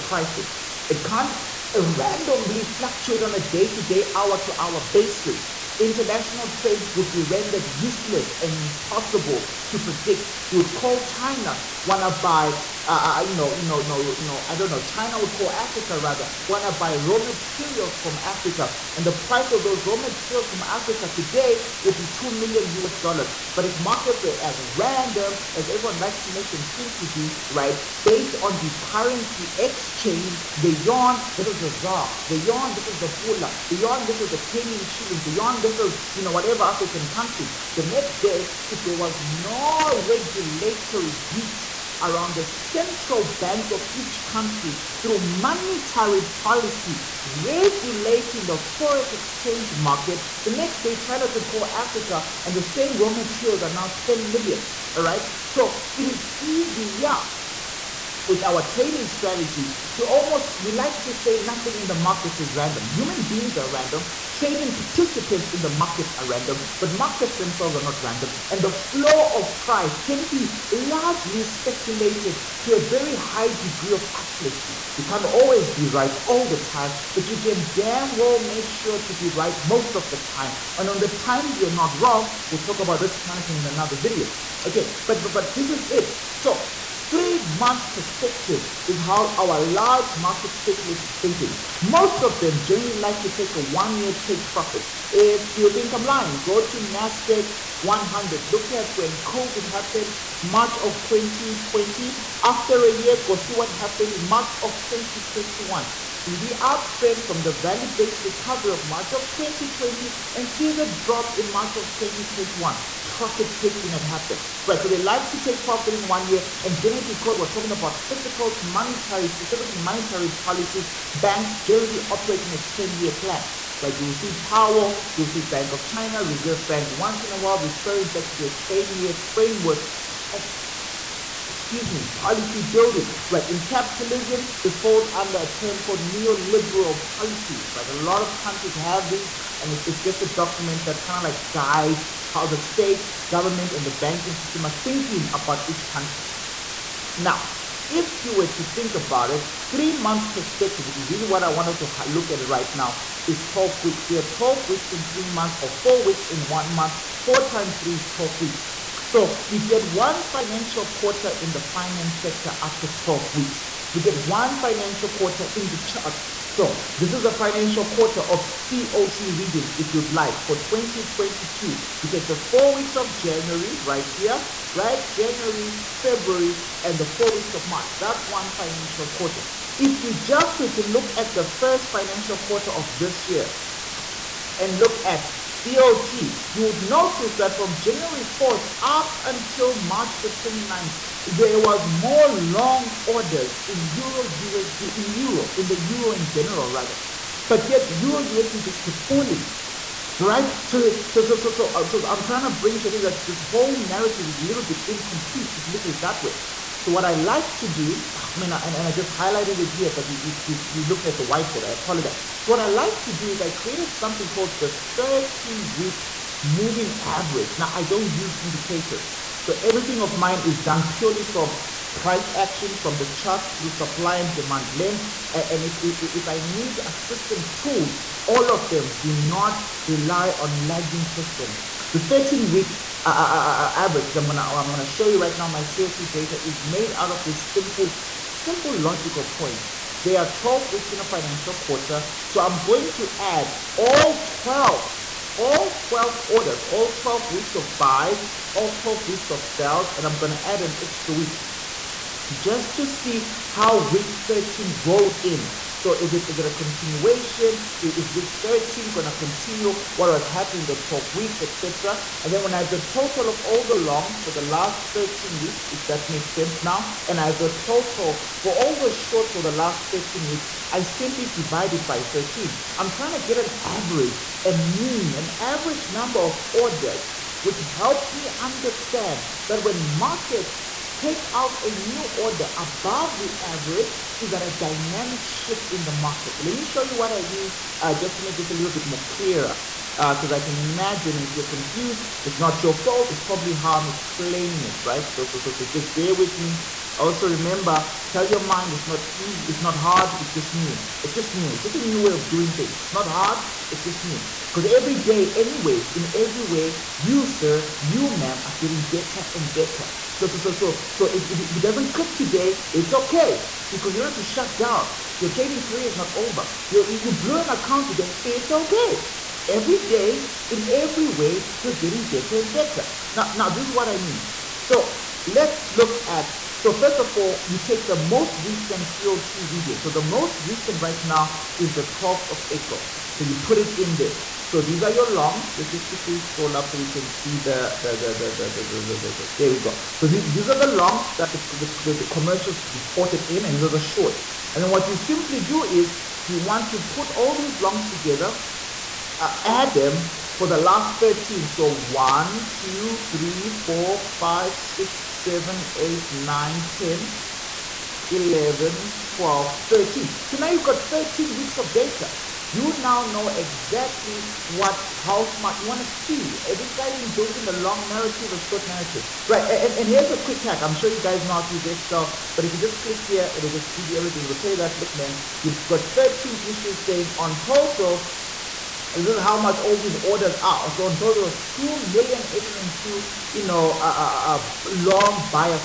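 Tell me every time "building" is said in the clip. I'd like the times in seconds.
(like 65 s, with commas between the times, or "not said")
132 s, 367 s.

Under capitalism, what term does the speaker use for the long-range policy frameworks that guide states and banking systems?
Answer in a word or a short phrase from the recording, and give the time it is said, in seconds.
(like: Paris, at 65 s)
neoliberal policies, at 136 s.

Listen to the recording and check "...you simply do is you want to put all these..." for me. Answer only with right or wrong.
right.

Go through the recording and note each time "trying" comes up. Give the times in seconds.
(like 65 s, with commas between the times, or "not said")
202 s, 272 s.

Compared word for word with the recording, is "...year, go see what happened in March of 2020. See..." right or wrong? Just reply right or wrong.
wrong.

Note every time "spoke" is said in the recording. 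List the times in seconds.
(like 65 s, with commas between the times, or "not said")
not said.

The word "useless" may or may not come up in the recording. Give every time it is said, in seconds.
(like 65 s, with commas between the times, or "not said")
7 s.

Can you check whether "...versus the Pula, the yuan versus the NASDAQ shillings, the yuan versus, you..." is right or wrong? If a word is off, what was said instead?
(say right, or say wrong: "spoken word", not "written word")
wrong: "Kenyan", not "NASDAQ".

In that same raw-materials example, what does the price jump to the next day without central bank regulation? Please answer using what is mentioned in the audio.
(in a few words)
10 million.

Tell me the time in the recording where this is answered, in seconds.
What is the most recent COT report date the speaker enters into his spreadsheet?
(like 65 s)
331 s.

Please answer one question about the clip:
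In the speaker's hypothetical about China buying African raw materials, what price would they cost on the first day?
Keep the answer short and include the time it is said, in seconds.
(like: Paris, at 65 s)
2 million US dollars, at 22 s.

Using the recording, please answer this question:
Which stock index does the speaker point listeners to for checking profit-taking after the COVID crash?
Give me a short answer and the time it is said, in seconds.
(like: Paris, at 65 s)
NASDAQ 100, at 96 s.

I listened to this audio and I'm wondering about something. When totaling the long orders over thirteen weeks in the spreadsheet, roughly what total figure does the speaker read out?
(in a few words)
2,802,000.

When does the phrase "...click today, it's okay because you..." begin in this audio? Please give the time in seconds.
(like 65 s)
311 s.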